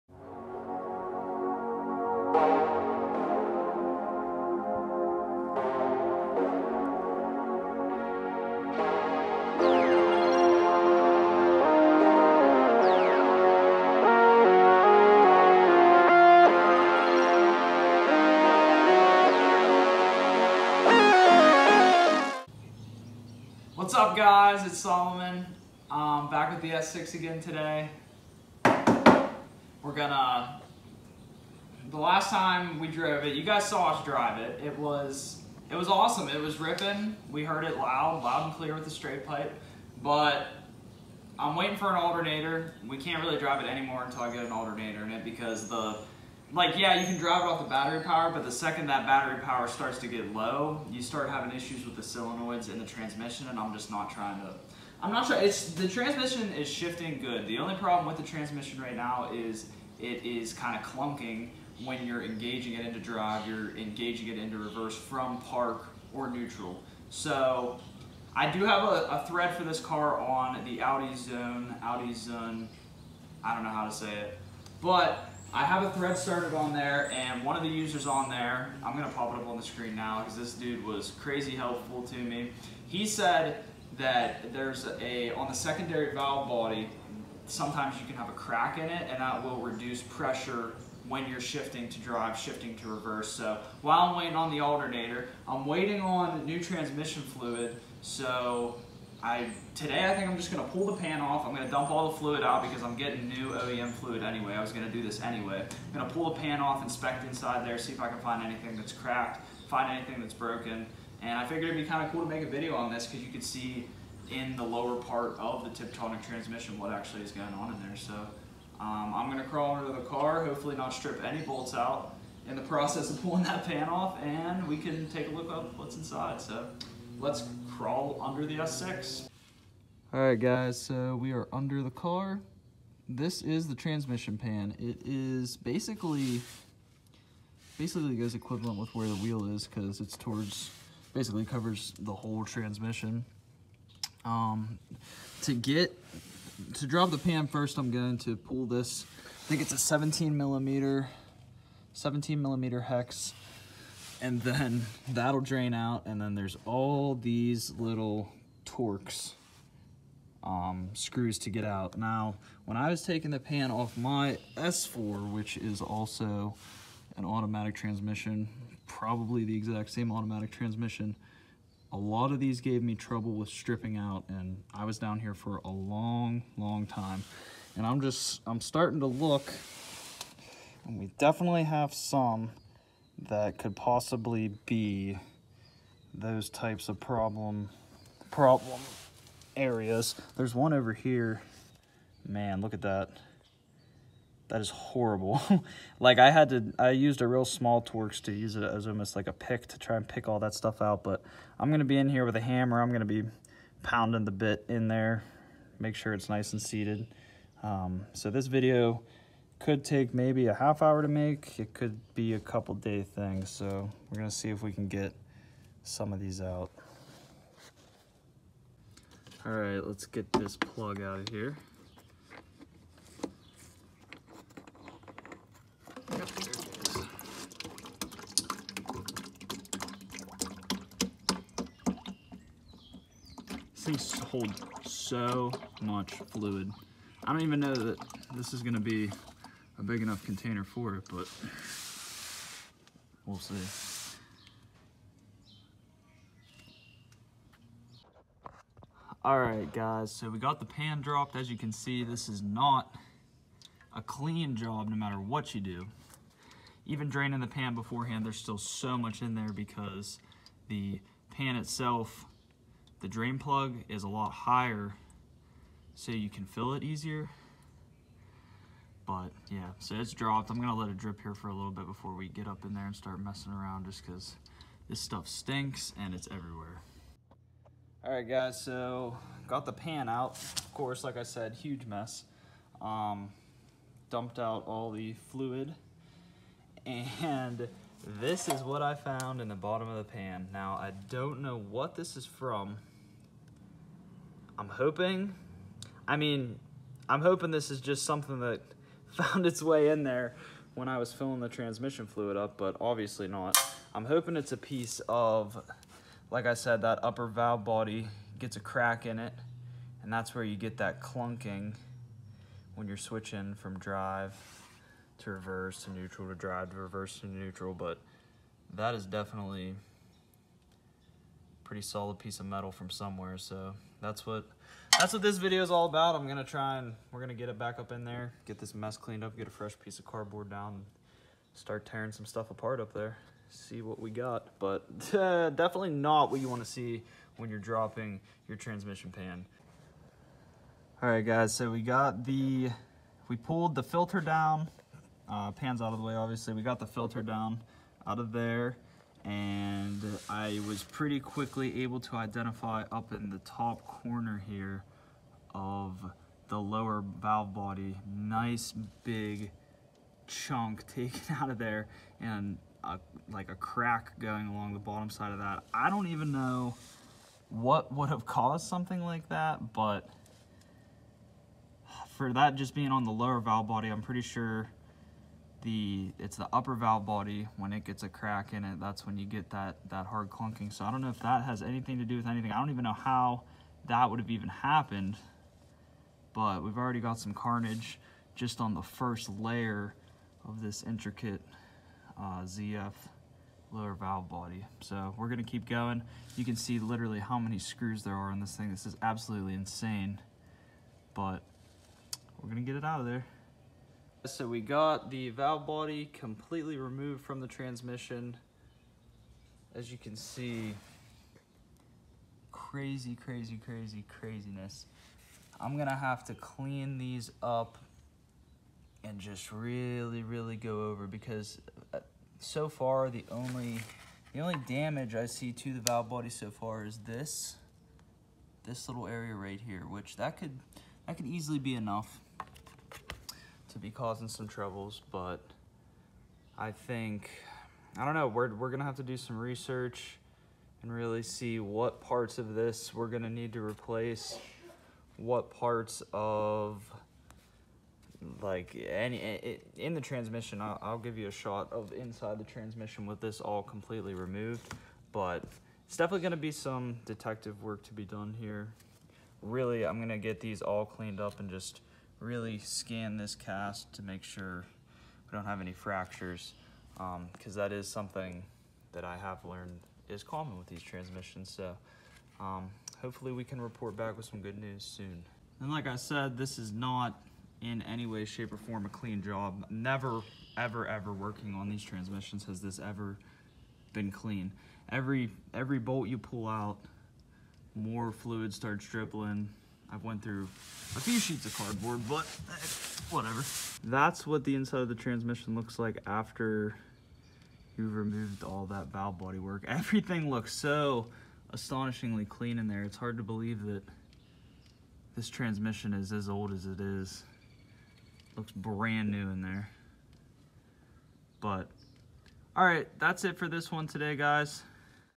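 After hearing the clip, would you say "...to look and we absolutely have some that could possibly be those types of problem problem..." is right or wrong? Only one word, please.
wrong.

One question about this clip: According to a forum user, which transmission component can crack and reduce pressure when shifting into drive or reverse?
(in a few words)
Secondary valve body.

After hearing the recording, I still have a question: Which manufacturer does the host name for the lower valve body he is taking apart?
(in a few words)
ZF.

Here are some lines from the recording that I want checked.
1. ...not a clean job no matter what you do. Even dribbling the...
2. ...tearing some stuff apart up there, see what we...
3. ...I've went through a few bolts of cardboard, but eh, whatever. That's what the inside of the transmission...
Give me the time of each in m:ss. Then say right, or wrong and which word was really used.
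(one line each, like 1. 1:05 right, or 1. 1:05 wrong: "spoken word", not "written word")
1. 4:12 wrong: "draining", not "dribbling"
2. 5:31 right
3. 8:09 wrong: "sheets", not "bolts".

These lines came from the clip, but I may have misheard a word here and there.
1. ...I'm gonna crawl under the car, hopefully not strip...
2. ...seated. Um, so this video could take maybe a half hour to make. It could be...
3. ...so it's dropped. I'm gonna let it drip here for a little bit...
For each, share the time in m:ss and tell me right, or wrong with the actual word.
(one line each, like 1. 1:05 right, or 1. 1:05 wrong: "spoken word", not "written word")
1. 1:59 right
2. 3:26 right
3. 4:29 right.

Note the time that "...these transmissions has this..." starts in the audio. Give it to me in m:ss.
8:01.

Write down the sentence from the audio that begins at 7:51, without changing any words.
So um, hopefully we can report back with some good news soon.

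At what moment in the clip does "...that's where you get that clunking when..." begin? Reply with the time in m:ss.
5:10.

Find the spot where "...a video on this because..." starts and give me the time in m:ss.
1:52.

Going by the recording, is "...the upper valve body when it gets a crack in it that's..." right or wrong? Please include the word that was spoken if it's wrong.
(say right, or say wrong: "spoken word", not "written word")
right.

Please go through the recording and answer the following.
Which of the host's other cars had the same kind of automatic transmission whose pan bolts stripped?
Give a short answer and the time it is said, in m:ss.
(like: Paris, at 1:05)
S4, at 2:44.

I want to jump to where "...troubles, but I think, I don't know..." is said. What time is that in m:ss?
7:14.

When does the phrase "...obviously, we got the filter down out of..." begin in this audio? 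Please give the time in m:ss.
5:46.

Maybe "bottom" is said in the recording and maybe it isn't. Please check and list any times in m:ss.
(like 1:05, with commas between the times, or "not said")
4:49, 6:04.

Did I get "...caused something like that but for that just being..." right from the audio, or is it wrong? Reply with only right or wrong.
right.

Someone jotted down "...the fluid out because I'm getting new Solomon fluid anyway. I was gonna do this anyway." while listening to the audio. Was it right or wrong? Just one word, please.
wrong.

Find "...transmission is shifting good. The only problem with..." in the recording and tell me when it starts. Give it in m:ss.
0:55.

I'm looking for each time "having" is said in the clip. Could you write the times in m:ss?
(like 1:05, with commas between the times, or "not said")
0:51.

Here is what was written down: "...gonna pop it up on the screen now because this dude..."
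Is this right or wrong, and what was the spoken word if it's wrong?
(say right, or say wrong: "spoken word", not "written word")
right.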